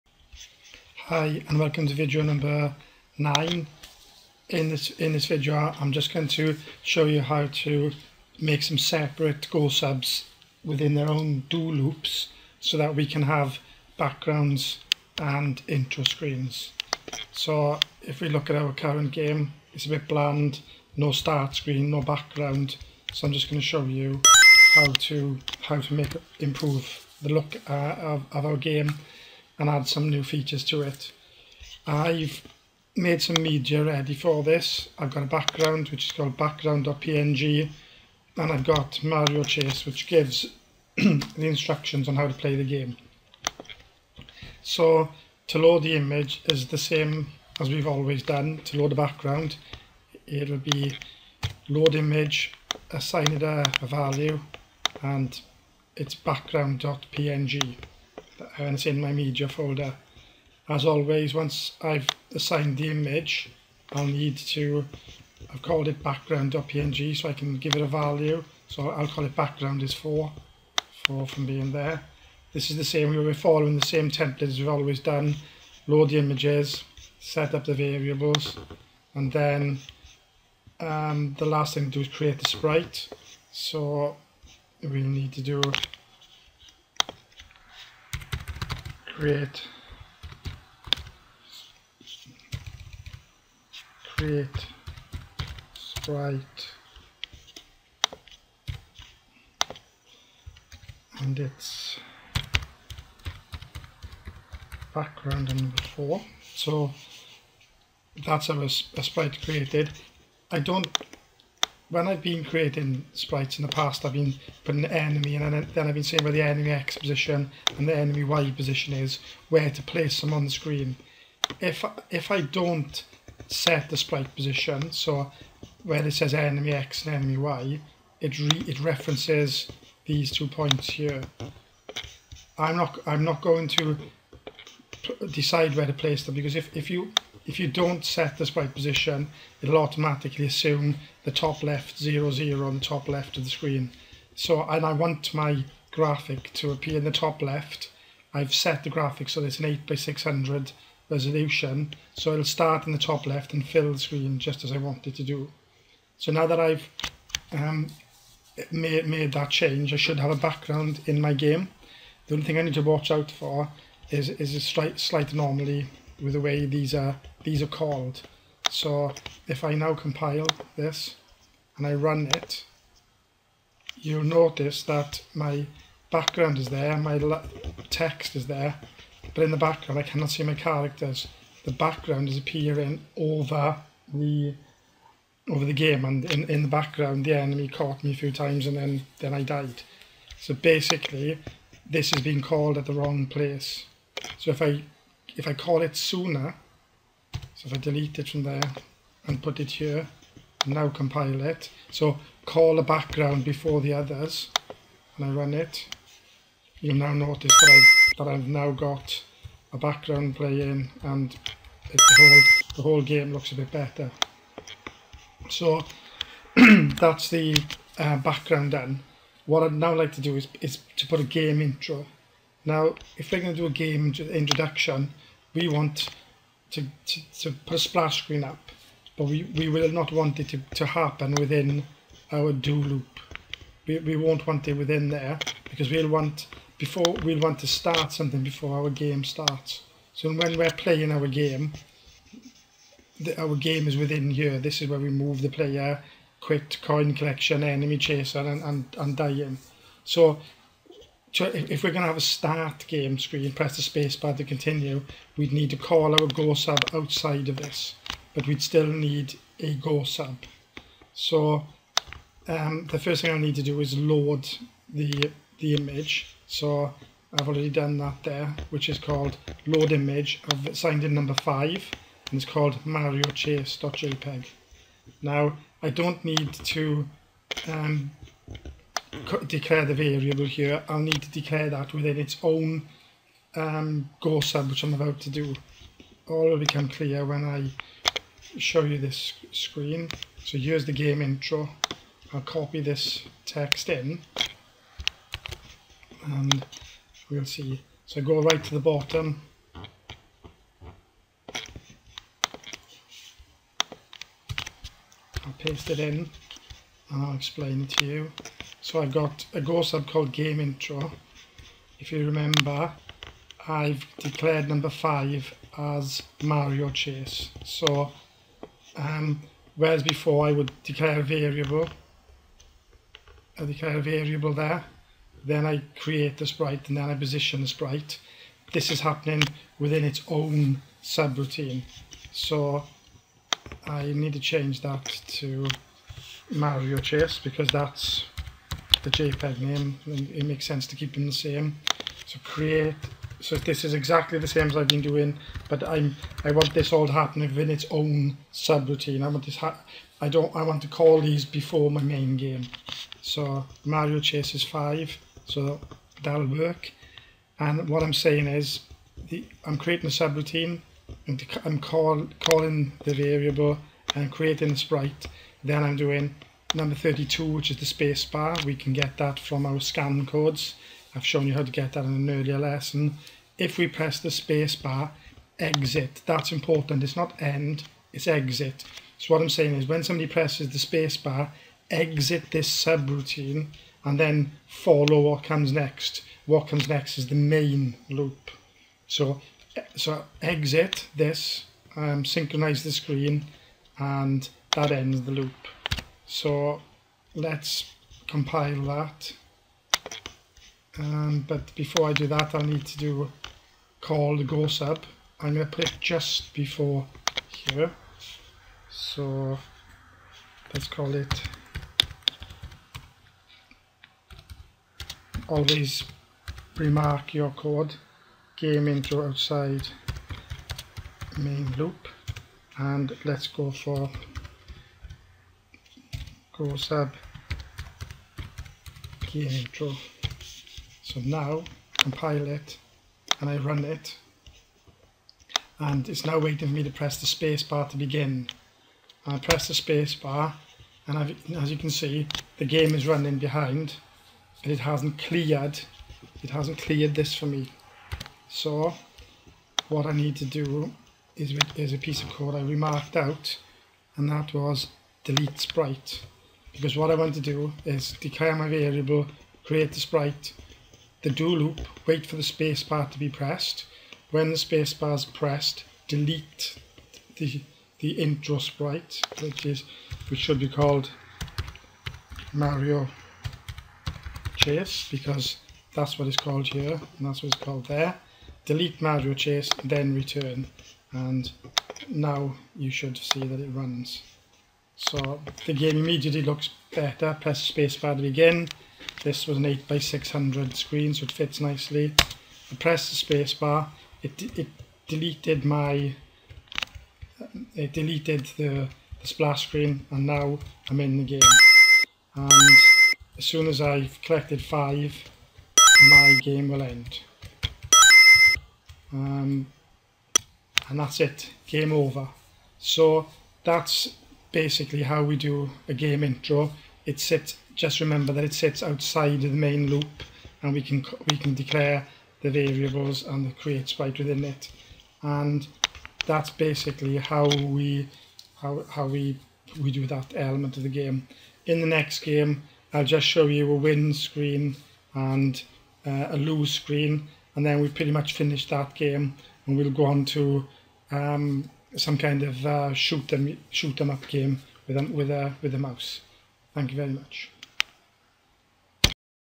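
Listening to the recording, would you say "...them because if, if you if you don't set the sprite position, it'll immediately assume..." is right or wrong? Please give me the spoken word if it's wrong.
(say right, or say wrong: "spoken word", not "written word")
wrong: "automatically", not "immediately".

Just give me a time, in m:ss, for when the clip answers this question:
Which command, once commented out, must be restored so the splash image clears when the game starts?
7:35.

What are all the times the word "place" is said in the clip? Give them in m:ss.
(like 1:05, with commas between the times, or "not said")
1:59, 2:15, 3:13.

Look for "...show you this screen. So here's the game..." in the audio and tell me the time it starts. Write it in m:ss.
4:48.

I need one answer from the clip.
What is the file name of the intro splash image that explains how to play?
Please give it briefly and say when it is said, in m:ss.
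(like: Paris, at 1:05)
mariochase.jpg, at 4:32.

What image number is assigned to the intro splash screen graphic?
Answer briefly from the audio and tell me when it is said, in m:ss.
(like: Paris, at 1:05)
5, at 4:31.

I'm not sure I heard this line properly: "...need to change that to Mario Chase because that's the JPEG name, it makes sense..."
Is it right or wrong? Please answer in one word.
right.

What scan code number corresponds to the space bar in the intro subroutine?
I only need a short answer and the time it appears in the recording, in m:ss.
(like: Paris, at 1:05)
32, at 6:06.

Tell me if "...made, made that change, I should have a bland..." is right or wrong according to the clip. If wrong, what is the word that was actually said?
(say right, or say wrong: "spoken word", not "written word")
wrong: "background", not "bland".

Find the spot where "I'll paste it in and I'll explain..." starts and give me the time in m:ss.
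5:05.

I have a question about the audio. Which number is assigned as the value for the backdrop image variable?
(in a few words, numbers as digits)
4.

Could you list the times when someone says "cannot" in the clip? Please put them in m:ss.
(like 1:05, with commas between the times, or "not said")
3:00.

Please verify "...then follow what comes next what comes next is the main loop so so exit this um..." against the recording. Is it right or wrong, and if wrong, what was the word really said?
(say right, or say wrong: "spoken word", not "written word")
right.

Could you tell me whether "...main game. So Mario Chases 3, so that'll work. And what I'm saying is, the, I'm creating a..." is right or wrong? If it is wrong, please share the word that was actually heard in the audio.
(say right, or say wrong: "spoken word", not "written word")
wrong: "5", not "3".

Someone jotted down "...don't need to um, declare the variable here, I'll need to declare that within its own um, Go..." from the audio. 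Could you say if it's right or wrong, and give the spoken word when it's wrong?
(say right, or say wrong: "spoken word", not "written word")
right.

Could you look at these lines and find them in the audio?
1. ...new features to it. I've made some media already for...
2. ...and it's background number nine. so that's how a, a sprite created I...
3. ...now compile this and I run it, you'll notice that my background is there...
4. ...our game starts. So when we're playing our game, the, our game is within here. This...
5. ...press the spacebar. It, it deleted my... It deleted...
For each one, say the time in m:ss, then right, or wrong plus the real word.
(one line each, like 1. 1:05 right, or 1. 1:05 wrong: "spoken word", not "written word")
1. 0:30 wrong: "ready", not "already"
2. 1:41 wrong: "four", not "nine"
3. 2:49 right
4. 3:58 right
5. 8:12 right.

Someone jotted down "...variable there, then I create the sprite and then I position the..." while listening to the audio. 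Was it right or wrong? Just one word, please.
right.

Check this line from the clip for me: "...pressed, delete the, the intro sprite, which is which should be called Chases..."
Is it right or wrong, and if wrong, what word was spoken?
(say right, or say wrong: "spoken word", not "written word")
wrong: "Mario", not "Chases".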